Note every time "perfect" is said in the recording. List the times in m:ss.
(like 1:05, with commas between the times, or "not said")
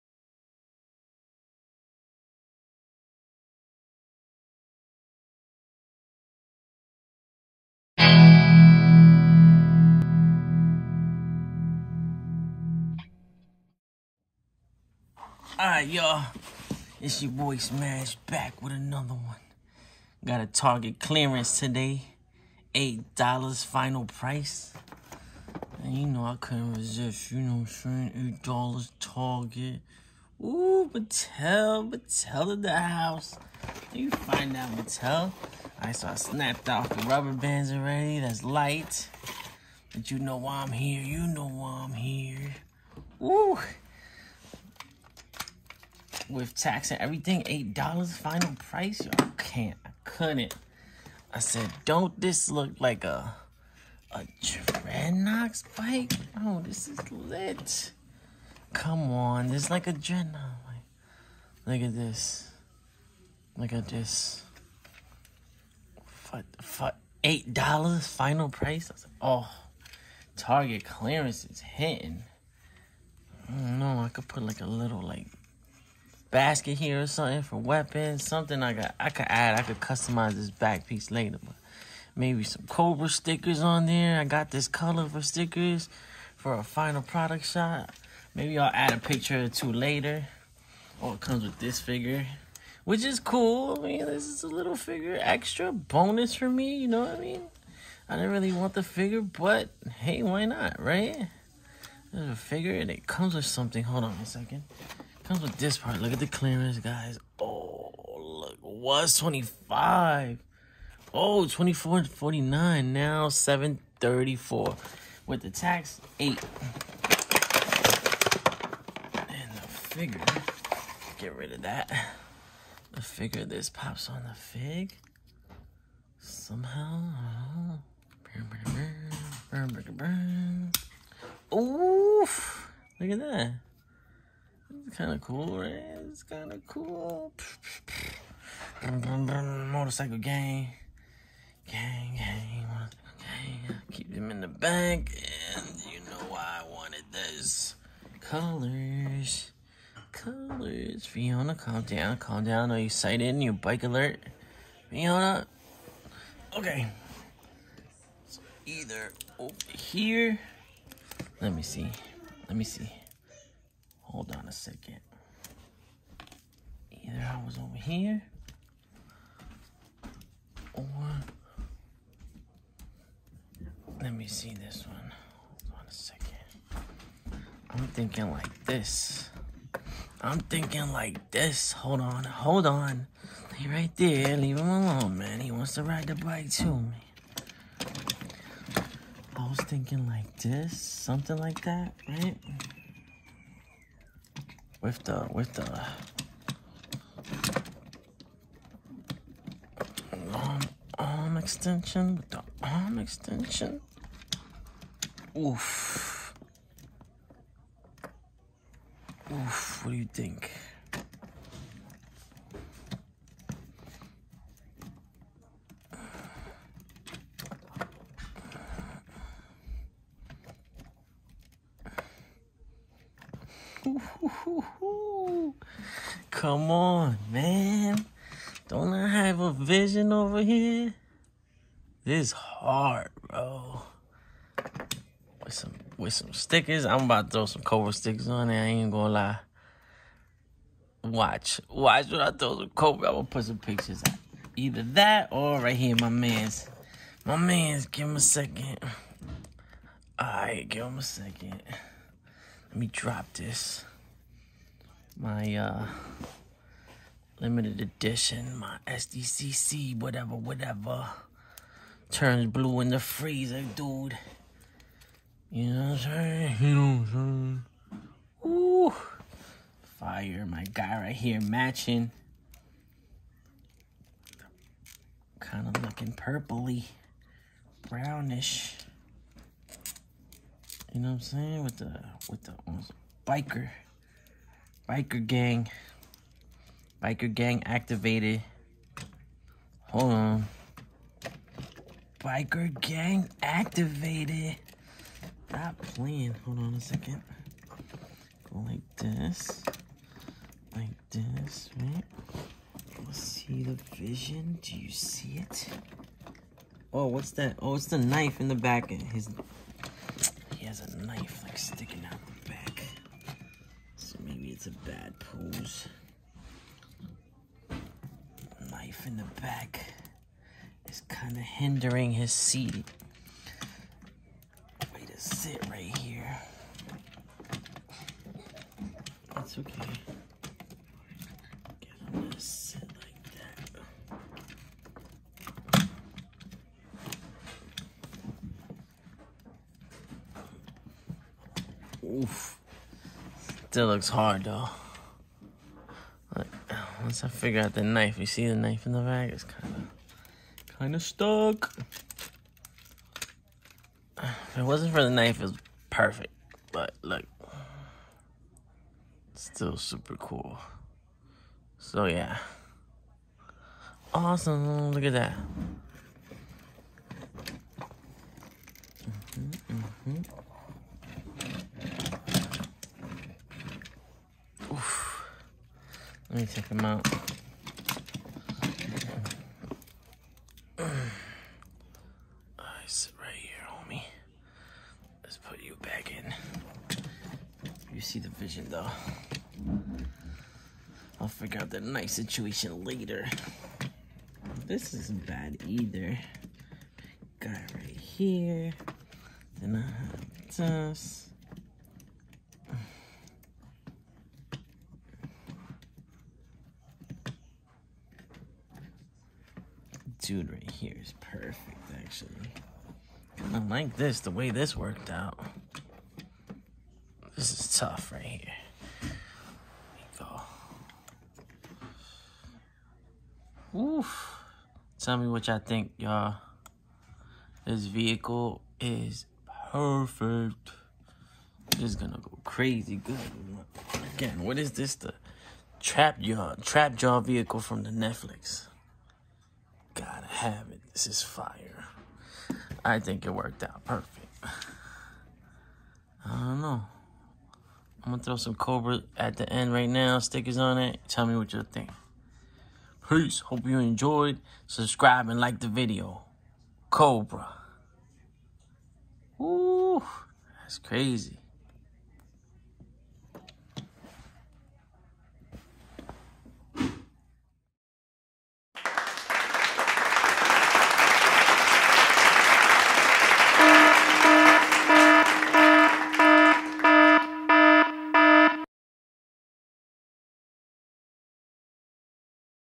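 5:55, 6:51, 7:09, 7:23.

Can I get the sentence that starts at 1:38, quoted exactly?
I didn't really want the figure, but hey, why not, right?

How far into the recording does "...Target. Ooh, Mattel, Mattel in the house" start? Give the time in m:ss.
0:28.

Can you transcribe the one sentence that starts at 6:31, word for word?
I'll figure out the knife situation later.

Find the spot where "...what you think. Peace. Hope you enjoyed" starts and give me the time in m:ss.
7:31.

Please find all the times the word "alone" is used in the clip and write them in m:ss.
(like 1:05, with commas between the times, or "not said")
3:04.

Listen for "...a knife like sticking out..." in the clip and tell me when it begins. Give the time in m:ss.
5:10.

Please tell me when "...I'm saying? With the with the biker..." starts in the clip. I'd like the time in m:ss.
4:41.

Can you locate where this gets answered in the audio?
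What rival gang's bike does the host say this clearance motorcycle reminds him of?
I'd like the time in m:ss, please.
0:54.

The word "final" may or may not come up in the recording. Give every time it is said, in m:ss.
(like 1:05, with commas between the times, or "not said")
0:23, 0:48, 1:08, 1:26.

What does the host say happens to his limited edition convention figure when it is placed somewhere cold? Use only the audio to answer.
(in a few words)
Turns blue.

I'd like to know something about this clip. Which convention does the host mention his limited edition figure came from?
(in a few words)
SDCC.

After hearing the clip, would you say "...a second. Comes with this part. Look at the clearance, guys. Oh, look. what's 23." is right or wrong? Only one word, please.
wrong.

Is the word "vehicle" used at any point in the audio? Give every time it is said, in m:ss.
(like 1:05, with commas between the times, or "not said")
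7:07, 7:17.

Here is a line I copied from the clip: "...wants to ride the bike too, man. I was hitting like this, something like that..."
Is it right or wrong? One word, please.
wrong.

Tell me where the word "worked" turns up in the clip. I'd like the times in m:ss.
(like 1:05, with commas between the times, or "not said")
6:54, 7:23.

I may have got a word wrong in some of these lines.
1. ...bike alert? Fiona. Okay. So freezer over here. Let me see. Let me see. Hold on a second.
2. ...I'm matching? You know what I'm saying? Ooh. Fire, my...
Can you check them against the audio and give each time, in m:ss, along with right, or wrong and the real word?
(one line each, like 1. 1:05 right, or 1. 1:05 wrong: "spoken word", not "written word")
1. 2:33 wrong: "either", not "freezer"
2. 4:25 wrong: "saying", not "matching".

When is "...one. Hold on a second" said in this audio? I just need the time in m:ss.
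2:54.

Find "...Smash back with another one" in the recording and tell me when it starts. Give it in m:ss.
0:17.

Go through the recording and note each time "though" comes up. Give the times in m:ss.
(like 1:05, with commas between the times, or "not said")
5:44, 6:28.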